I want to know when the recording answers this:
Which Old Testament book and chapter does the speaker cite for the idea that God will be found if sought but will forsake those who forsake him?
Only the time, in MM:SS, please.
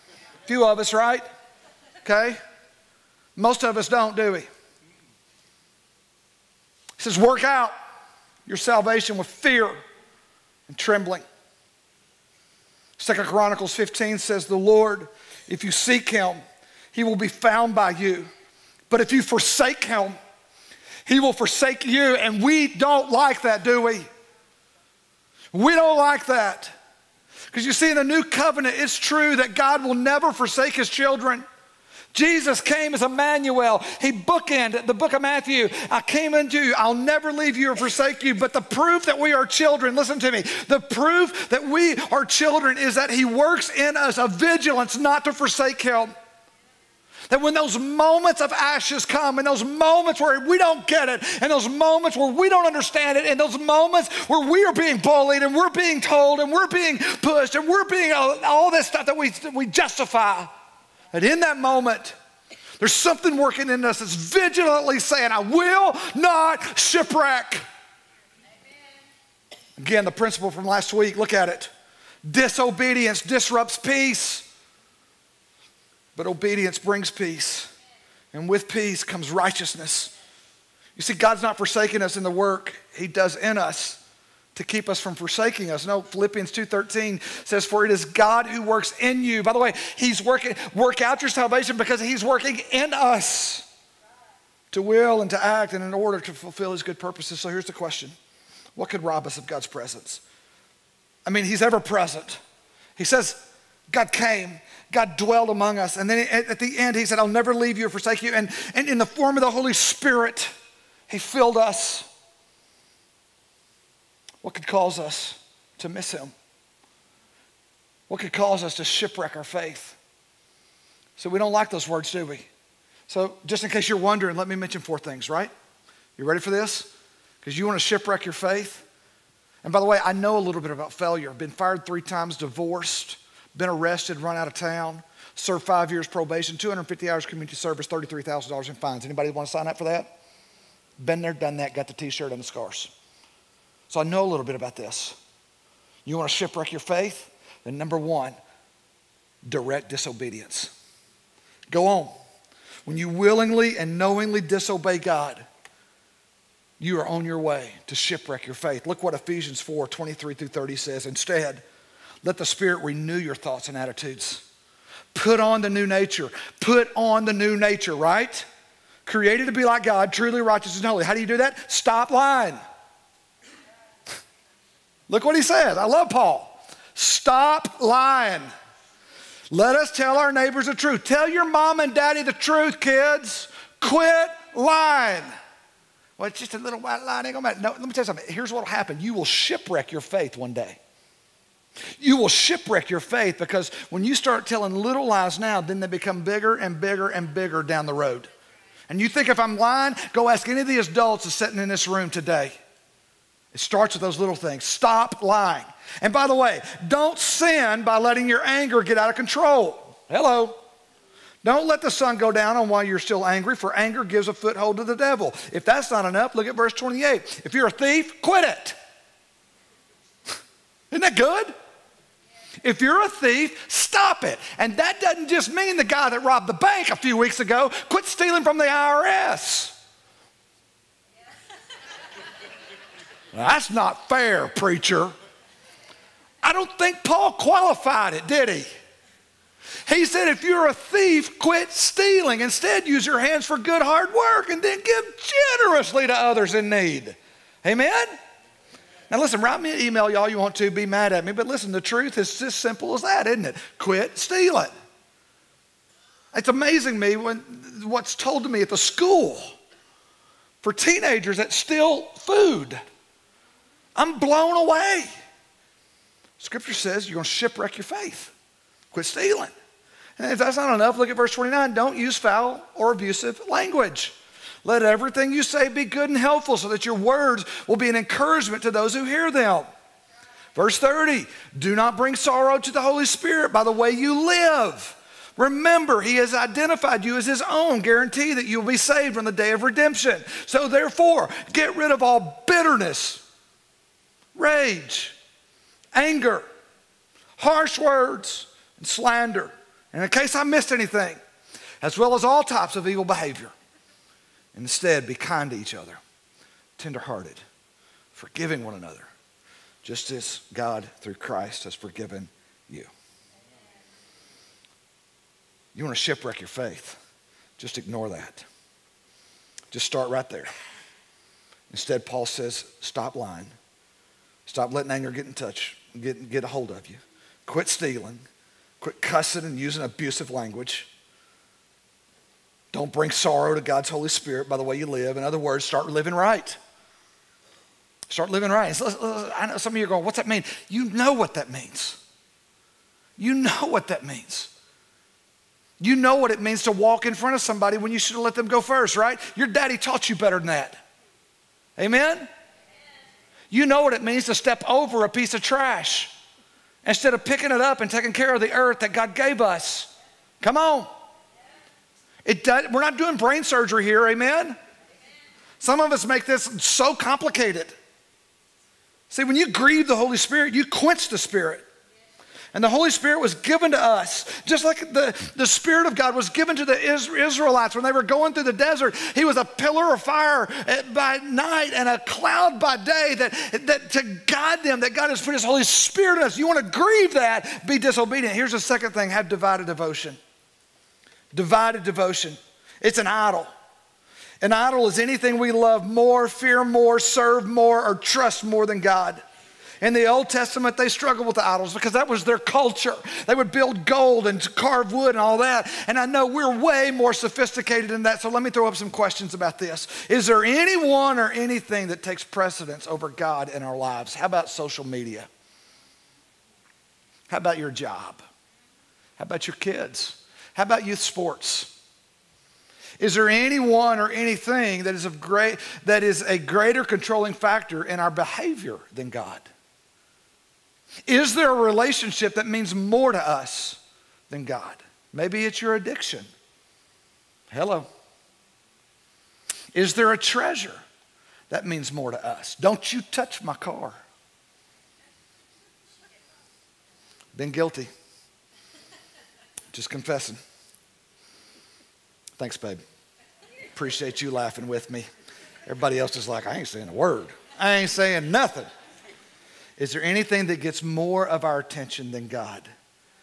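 00:12.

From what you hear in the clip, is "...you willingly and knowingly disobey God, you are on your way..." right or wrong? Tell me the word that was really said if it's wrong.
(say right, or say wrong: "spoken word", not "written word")
right.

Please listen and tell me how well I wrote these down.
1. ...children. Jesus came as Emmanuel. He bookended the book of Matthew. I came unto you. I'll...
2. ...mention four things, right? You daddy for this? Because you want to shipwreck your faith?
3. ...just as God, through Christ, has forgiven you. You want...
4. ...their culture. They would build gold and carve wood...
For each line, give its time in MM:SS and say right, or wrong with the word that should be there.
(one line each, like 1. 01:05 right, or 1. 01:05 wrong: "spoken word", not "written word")
1. 00:30 right
2. 02:04 wrong: "ready", not "daddy"
3. 05:09 right
4. 06:42 right.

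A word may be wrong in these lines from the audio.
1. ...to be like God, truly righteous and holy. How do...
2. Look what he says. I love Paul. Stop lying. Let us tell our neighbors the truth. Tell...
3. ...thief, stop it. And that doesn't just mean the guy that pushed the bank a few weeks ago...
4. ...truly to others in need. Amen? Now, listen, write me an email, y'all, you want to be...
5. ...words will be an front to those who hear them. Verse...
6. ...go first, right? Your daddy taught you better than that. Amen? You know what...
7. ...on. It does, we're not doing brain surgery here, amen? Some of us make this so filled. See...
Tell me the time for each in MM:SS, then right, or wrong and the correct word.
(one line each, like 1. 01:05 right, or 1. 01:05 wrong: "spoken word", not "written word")
1. 02:49 right
2. 02:55 right
3. 03:43 wrong: "robbed", not "pushed"
4. 04:05 wrong: "generously", not "truly"
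5. 04:36 wrong: "encouragement", not "front"
6. 05:48 right
7. 06:00 wrong: "complicated", not "filled".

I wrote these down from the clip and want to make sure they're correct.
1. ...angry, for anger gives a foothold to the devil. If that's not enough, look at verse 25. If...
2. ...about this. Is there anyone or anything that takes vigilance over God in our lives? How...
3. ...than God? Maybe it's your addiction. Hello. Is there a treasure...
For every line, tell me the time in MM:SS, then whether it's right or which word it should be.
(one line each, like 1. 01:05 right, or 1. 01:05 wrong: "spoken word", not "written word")
1. 03:33 wrong: "28", not "25"
2. 06:49 wrong: "precedence", not "vigilance"
3. 07:14 right.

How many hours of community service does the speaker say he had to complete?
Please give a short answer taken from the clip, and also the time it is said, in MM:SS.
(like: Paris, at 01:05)
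250 hours, at 02:16.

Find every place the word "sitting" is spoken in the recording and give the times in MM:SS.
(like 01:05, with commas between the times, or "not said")
03:21.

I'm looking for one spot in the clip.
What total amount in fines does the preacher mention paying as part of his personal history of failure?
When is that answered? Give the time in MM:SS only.
02:17.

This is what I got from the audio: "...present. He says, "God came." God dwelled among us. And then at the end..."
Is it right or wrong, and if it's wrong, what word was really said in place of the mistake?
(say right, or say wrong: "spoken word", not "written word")
right.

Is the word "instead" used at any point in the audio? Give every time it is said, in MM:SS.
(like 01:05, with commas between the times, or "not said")
02:41, 04:02, 05:04, 05:21, 05:56.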